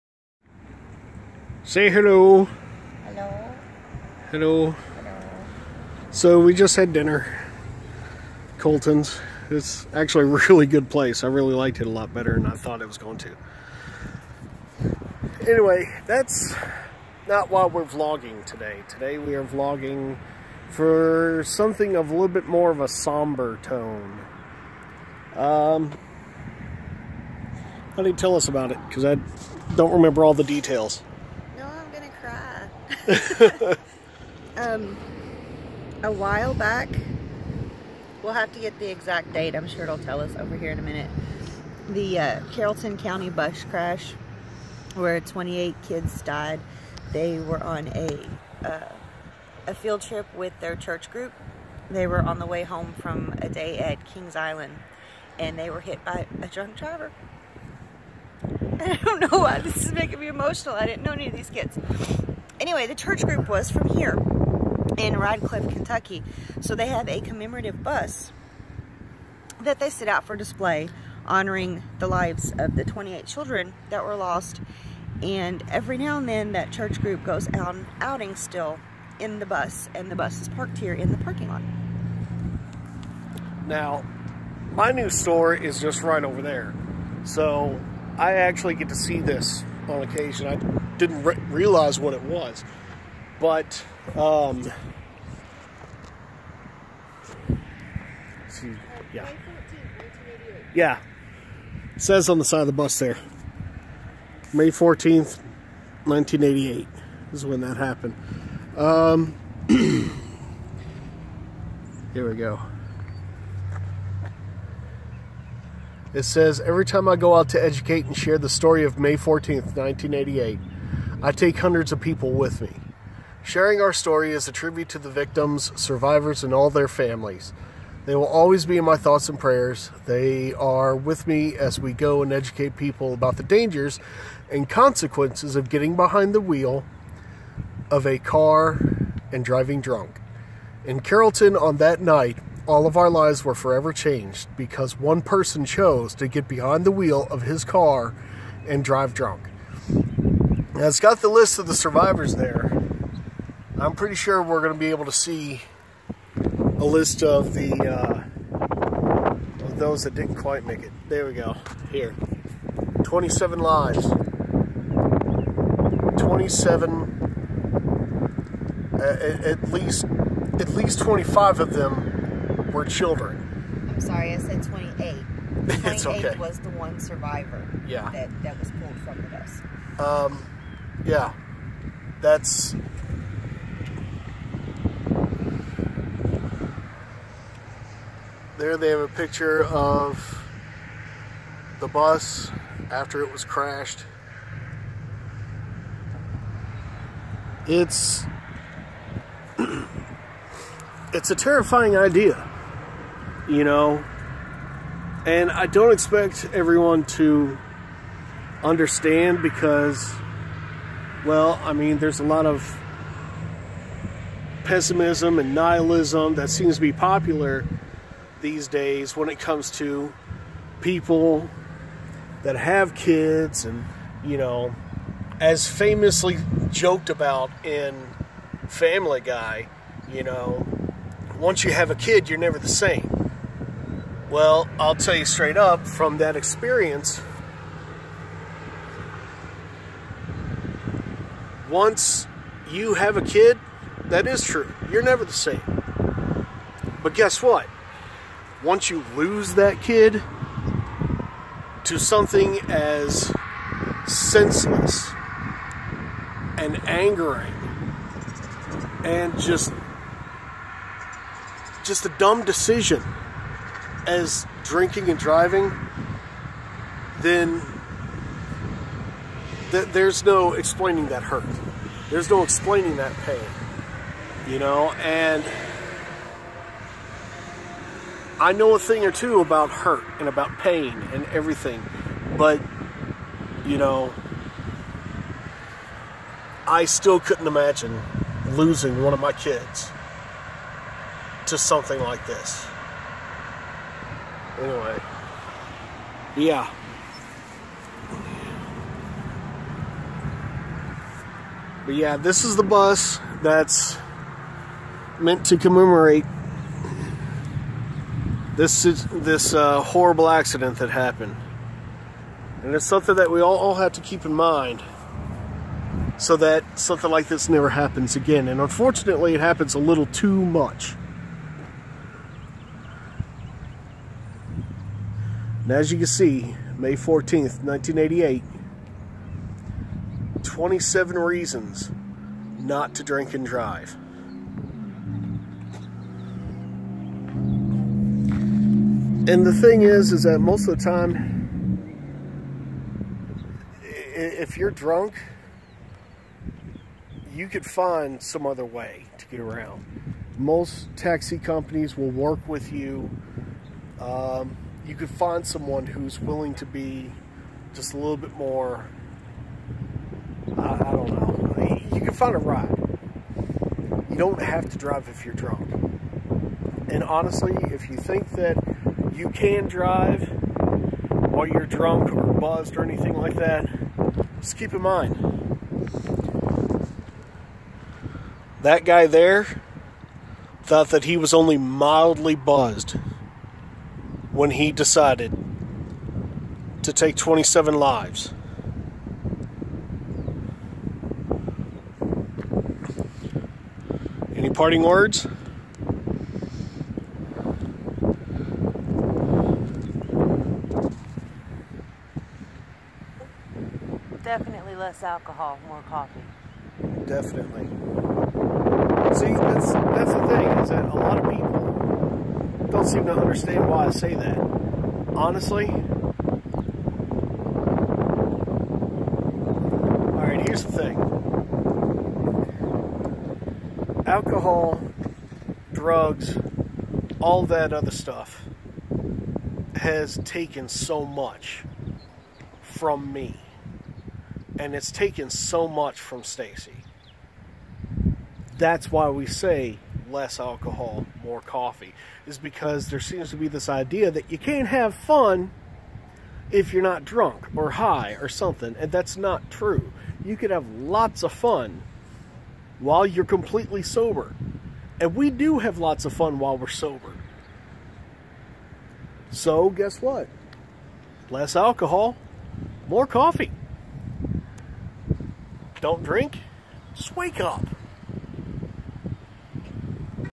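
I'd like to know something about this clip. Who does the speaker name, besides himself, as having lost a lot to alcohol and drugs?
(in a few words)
Stacey.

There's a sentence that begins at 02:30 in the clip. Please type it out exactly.
Now it's got the list of the survivors there.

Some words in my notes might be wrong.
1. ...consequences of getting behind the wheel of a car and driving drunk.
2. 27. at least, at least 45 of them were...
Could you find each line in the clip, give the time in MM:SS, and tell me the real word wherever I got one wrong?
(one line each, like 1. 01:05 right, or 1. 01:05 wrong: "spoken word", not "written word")
1. 02:14 right
2. 02:46 wrong: "25", not "45".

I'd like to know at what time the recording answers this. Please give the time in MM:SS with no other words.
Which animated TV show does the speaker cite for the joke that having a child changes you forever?
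03:48.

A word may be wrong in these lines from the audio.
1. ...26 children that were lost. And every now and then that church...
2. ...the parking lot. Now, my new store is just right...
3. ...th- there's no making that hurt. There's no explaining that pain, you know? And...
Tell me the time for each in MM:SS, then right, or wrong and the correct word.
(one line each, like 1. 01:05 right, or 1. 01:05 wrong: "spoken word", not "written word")
1. 01:12 wrong: "28", not "26"
2. 01:21 right
3. 04:29 wrong: "explaining", not "making".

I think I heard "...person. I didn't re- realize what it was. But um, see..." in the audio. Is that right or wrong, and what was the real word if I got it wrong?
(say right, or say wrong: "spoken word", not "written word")
wrong: "occasion", not "person".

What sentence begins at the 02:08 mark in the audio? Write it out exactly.
They will always be in my thoughts and prayers.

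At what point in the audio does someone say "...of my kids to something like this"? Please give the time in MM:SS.
04:49.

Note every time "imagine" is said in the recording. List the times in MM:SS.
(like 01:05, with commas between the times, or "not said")
04:47.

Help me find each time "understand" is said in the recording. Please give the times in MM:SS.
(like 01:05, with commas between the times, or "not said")
03:28, 06:53.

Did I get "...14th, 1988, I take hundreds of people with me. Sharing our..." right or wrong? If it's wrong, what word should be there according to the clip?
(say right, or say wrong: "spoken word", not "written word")
right.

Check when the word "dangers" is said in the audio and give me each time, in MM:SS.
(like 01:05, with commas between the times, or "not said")
02:13.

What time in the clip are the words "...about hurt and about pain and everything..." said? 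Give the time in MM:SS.
04:39.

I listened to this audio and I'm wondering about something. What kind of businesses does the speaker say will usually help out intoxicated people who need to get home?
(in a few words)
Taxi companies.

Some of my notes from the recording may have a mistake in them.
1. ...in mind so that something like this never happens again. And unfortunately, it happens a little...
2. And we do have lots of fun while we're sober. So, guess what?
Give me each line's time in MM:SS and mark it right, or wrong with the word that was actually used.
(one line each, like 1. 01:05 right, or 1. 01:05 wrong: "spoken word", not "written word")
1. 05:14 right
2. 07:34 right.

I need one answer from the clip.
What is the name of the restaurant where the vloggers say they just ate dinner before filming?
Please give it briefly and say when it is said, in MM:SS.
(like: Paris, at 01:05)
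Colton's, at 00:08.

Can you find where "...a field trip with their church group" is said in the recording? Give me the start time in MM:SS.
00:49.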